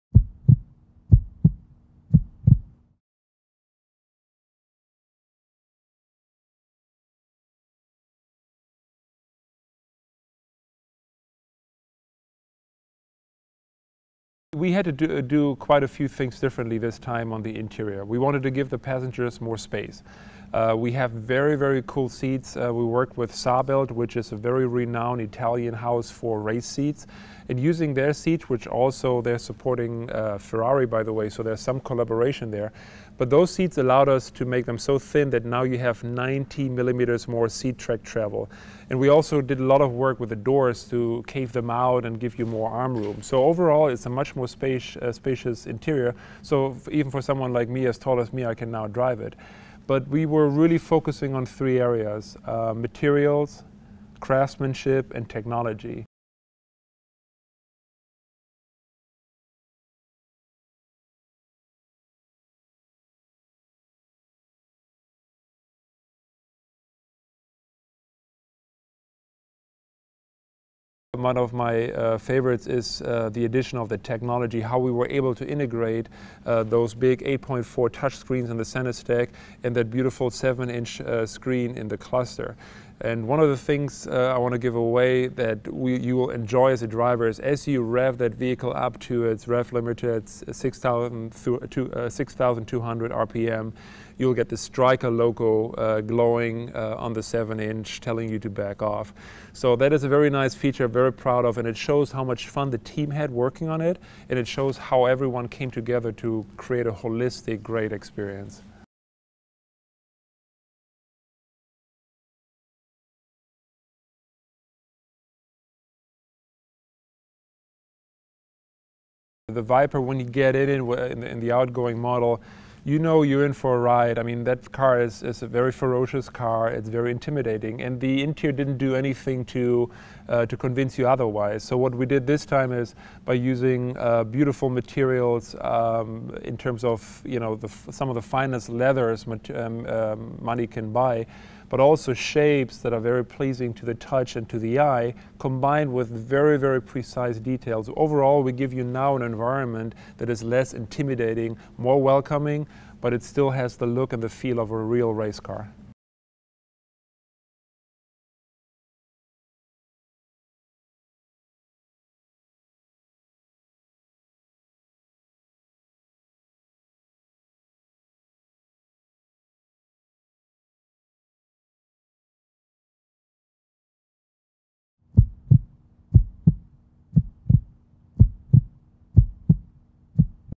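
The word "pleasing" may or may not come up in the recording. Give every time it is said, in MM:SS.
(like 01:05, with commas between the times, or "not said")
02:23.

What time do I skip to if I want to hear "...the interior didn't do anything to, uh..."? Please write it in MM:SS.
02:08.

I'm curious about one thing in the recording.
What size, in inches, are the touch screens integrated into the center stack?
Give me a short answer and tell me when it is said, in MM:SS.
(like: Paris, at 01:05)
8.4, at 01:17.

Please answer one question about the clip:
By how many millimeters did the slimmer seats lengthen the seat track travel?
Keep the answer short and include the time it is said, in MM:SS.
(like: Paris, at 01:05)
90 millimeters, at 00:36.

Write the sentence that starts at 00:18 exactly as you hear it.
We wanted to give the passengers more space.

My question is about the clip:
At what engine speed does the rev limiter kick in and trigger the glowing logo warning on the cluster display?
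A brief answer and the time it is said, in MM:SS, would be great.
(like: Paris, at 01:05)
6,200 RPM, at 01:30.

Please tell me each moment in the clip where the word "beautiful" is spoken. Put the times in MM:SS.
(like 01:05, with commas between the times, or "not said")
01:19, 02:14.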